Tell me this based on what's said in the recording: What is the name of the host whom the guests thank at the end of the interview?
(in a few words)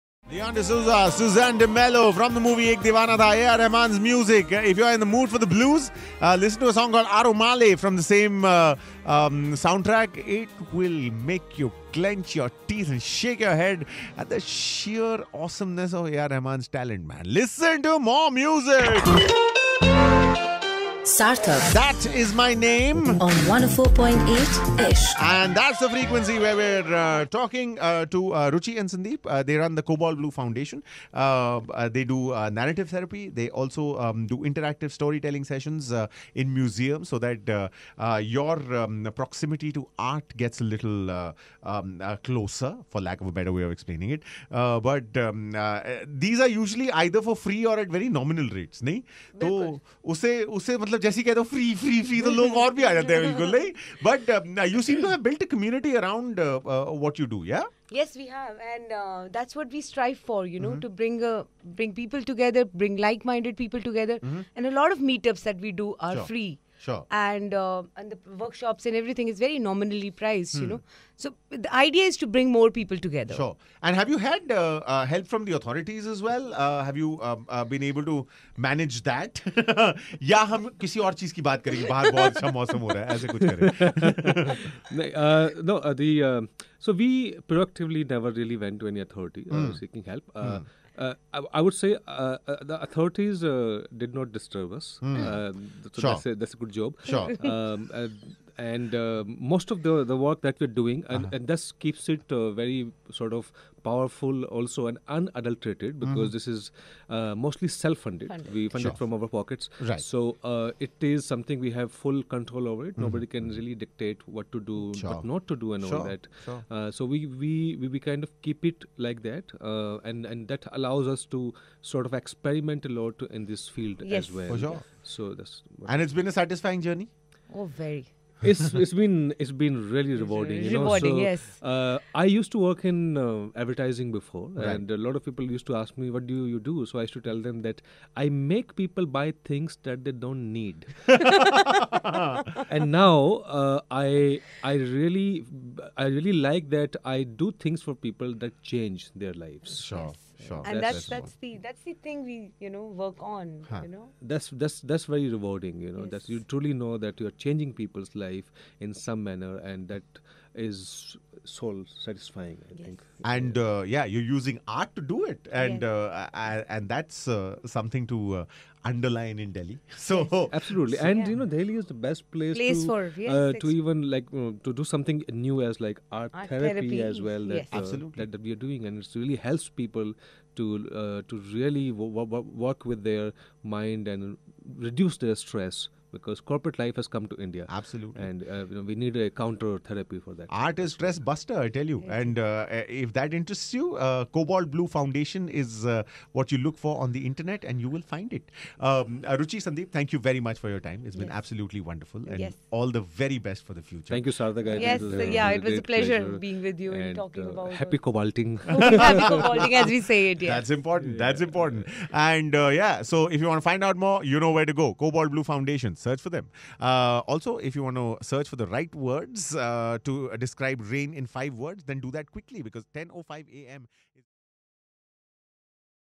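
Sarthak.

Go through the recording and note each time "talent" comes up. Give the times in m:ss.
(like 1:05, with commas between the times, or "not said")
0:16.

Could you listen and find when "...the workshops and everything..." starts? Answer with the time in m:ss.
1:08.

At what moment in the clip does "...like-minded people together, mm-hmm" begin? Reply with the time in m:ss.
1:03.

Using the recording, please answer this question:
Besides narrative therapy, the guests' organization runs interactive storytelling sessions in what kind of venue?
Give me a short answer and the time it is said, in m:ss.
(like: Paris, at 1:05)
museums, at 0:36.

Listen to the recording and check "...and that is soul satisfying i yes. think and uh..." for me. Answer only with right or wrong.
right.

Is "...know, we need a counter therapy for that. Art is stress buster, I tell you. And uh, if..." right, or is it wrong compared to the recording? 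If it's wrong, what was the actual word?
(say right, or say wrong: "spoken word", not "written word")
right.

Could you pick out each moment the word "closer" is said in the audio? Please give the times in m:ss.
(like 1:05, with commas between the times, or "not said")
0:42.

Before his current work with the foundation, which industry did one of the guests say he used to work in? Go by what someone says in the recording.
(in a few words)
advertising.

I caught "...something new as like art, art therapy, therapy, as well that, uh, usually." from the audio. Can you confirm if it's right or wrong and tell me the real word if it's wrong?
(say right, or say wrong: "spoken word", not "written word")
wrong: "absolutely", not "usually".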